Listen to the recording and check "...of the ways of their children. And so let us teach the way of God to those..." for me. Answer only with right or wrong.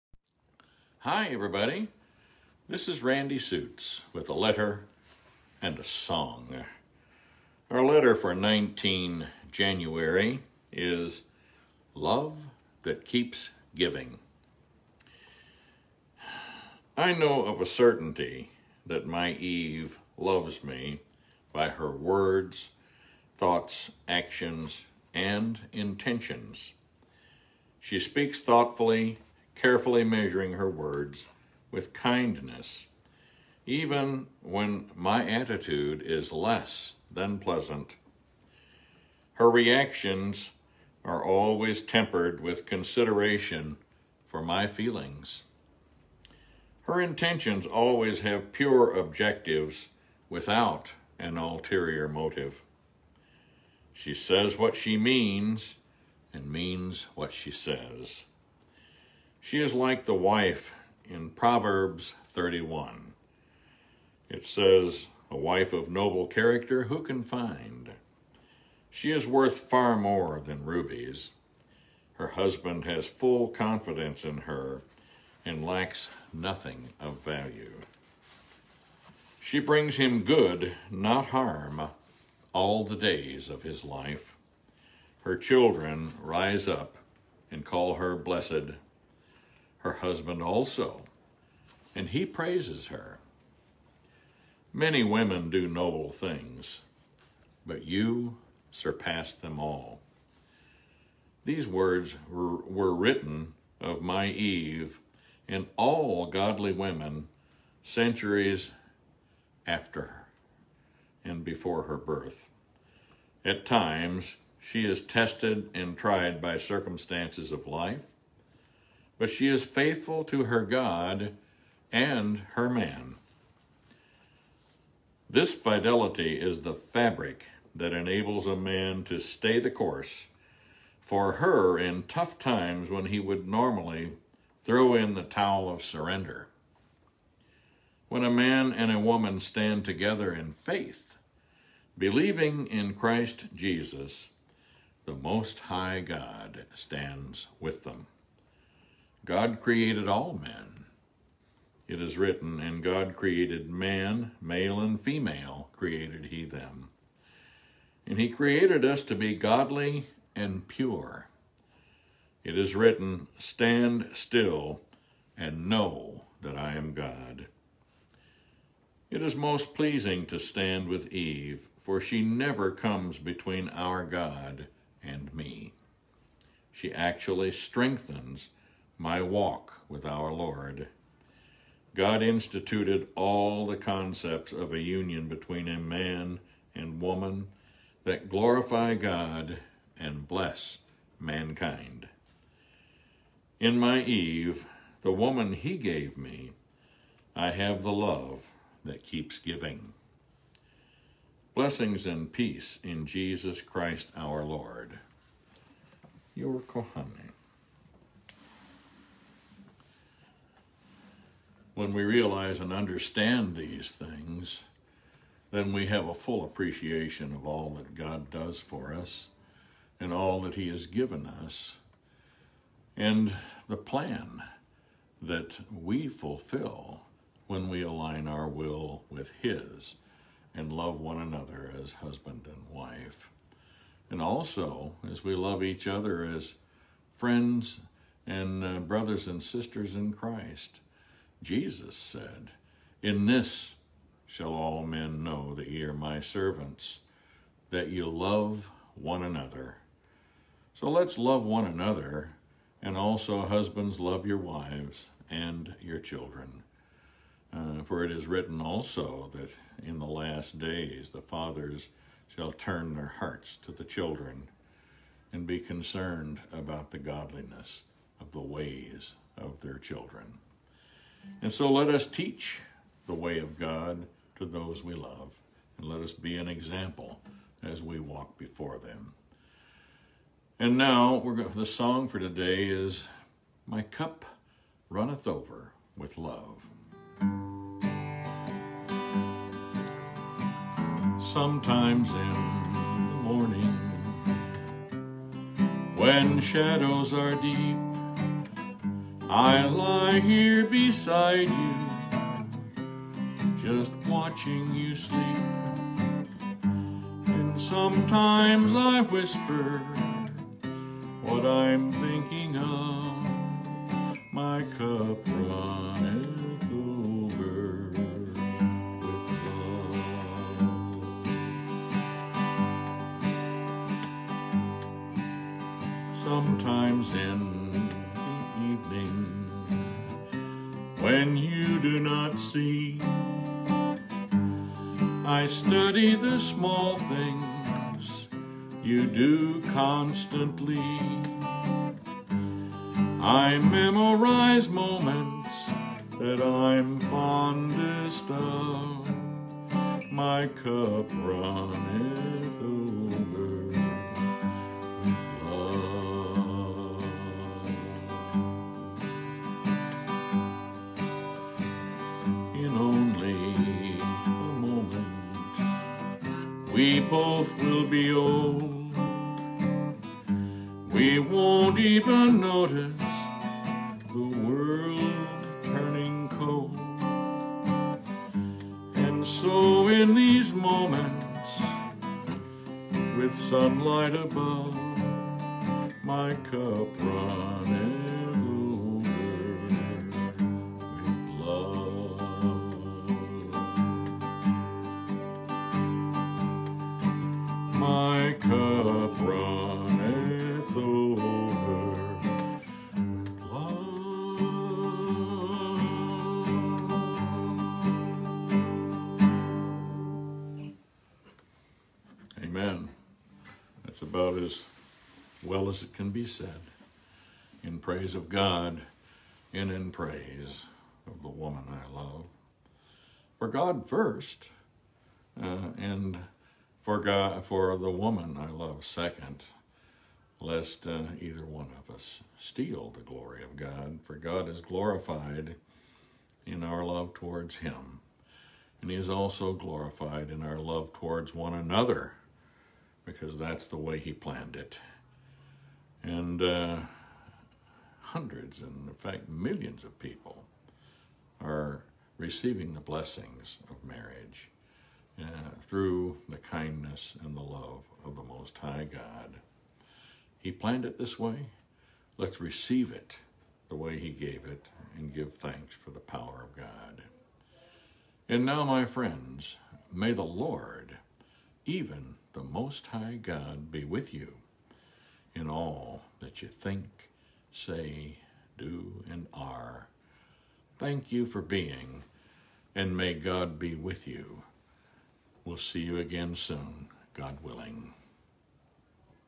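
right.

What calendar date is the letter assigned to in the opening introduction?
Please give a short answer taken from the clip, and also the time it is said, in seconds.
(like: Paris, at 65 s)
19 January, at 8 s.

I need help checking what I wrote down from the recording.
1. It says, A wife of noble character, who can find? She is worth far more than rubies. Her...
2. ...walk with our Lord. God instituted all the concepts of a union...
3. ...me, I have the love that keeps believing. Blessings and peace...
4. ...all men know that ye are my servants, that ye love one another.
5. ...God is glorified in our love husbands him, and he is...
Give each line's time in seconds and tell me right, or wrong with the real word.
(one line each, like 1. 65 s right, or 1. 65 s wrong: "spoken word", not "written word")
1. 64 s right
2. 179 s right
3. 196 s wrong: "giving", not "believing"
4. 244 s right
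5. 434 s wrong: "towards", not "husbands".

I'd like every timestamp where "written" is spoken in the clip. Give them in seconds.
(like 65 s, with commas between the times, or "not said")
102 s, 152 s, 162 s, 258 s.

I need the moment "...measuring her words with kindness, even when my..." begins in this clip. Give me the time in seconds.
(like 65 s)
30 s.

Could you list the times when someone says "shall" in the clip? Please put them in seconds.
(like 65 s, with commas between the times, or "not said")
244 s, 262 s.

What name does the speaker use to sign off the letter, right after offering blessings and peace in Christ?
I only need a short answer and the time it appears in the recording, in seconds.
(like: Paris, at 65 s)
Kohanim, at 206 s.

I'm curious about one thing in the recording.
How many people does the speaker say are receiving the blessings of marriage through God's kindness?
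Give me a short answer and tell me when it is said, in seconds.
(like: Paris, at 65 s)
Millions, at 449 s.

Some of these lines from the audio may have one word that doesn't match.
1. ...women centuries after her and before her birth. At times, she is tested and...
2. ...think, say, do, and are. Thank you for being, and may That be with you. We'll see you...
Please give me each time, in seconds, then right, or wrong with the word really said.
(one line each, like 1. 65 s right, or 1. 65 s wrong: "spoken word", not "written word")
1. 106 s right
2. 476 s wrong: "God", not "That".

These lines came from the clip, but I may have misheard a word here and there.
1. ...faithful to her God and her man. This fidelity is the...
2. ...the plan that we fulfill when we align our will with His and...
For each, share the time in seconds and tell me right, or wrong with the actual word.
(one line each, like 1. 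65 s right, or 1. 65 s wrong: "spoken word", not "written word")
1. 119 s right
2. 223 s right.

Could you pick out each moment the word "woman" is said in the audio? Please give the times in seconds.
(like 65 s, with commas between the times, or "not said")
138 s, 187 s, 195 s, 421 s, 427 s.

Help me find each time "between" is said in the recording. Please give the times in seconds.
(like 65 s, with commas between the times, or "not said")
173 s, 185 s.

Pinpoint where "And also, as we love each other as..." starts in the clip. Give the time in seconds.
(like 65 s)
234 s.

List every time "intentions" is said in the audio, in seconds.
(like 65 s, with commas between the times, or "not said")
25 s, 47 s.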